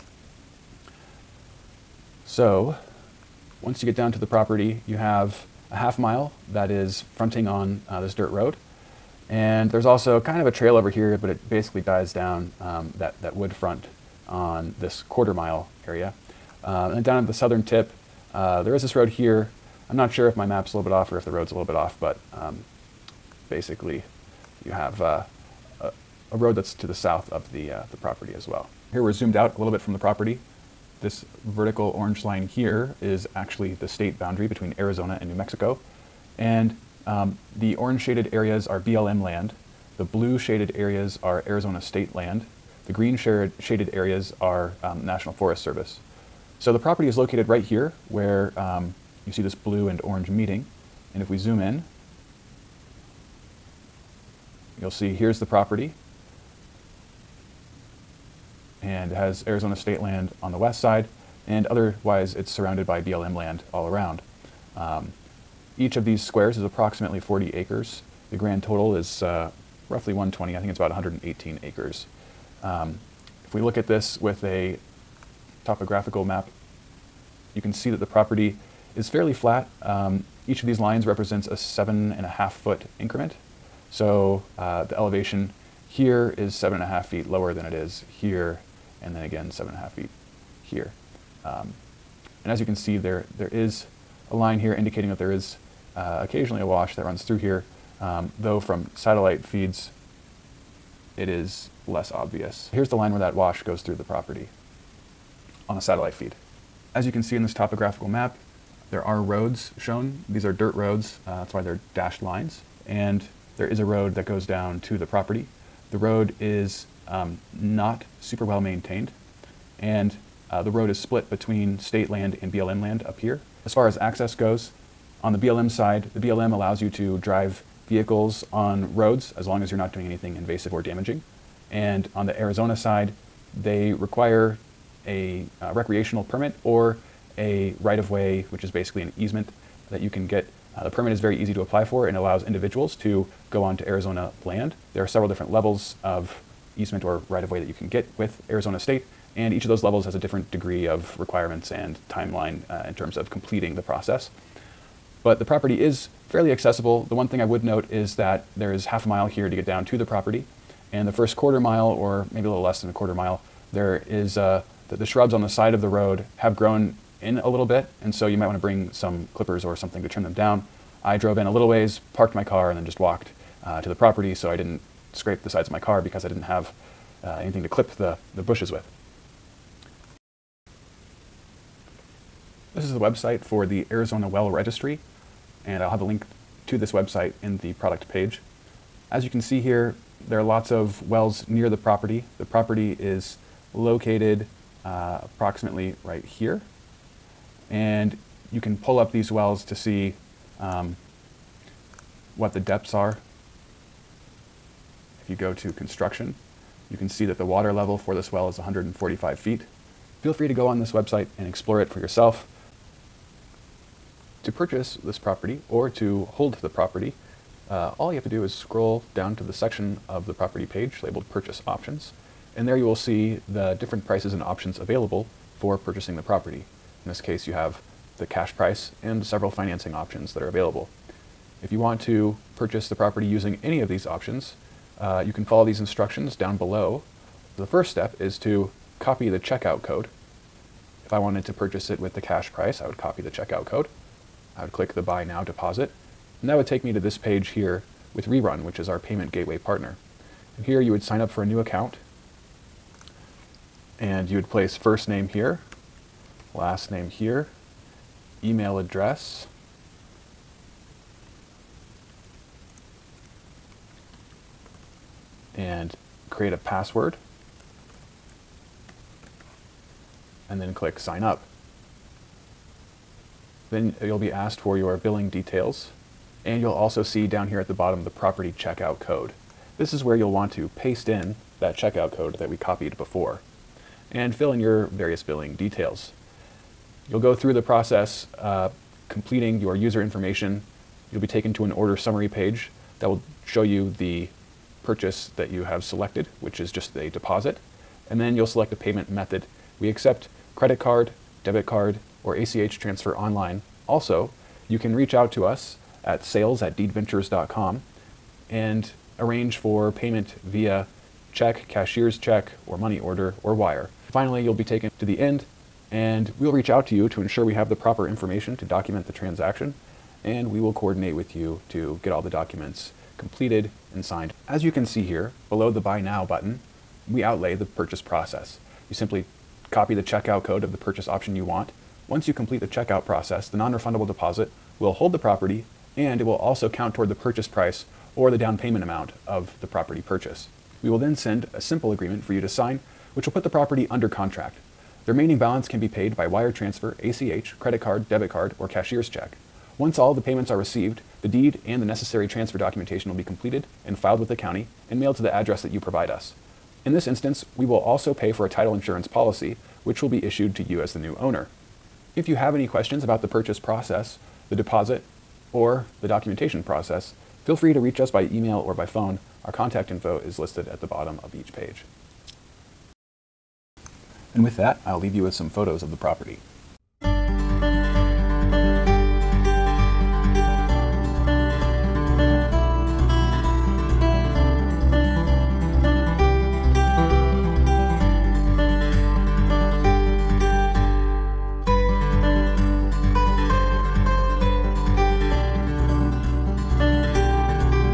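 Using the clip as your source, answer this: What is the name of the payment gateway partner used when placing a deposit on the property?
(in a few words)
Rerun.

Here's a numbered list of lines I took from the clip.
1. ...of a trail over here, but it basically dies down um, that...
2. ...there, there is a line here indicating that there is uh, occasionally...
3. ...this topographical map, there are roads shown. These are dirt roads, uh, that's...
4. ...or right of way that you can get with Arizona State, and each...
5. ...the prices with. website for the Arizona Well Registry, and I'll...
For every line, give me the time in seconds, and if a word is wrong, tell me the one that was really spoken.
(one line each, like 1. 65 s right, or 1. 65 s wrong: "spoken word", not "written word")
1. 10 s right
2. 92 s right
3. 107 s right
4. 147 s right
5. 178 s wrong: "bushes", not "prices".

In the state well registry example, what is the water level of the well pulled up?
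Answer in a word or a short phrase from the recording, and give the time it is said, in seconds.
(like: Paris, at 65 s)
145 feet, at 208 s.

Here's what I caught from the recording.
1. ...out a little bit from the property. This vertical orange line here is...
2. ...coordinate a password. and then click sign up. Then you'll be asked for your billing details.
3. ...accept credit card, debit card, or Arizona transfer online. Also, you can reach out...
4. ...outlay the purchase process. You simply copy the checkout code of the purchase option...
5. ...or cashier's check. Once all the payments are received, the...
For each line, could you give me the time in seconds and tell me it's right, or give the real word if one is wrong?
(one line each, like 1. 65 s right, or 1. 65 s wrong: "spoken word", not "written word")
1. 29 s right
2. 266 s wrong: "create", not "coordinate"
3. 299 s wrong: "ACH", not "Arizona"
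4. 327 s right
5. 348 s right.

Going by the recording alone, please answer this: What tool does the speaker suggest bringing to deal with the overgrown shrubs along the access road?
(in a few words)
Clippers.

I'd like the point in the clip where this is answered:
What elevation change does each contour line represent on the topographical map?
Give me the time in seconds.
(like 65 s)
81 s.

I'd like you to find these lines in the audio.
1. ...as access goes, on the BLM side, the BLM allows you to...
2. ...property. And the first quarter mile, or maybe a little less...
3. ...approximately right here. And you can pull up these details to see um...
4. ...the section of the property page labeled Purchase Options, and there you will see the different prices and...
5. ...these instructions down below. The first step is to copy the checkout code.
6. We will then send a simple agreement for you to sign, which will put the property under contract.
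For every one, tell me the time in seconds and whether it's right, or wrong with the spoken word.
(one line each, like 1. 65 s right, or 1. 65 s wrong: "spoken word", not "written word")
1. 123 s right
2. 160 s right
3. 195 s wrong: "wells", not "details"
4. 219 s right
5. 235 s right
6. 340 s right.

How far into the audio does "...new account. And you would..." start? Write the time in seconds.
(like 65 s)
251 s.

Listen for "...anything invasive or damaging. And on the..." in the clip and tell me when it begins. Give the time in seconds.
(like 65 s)
130 s.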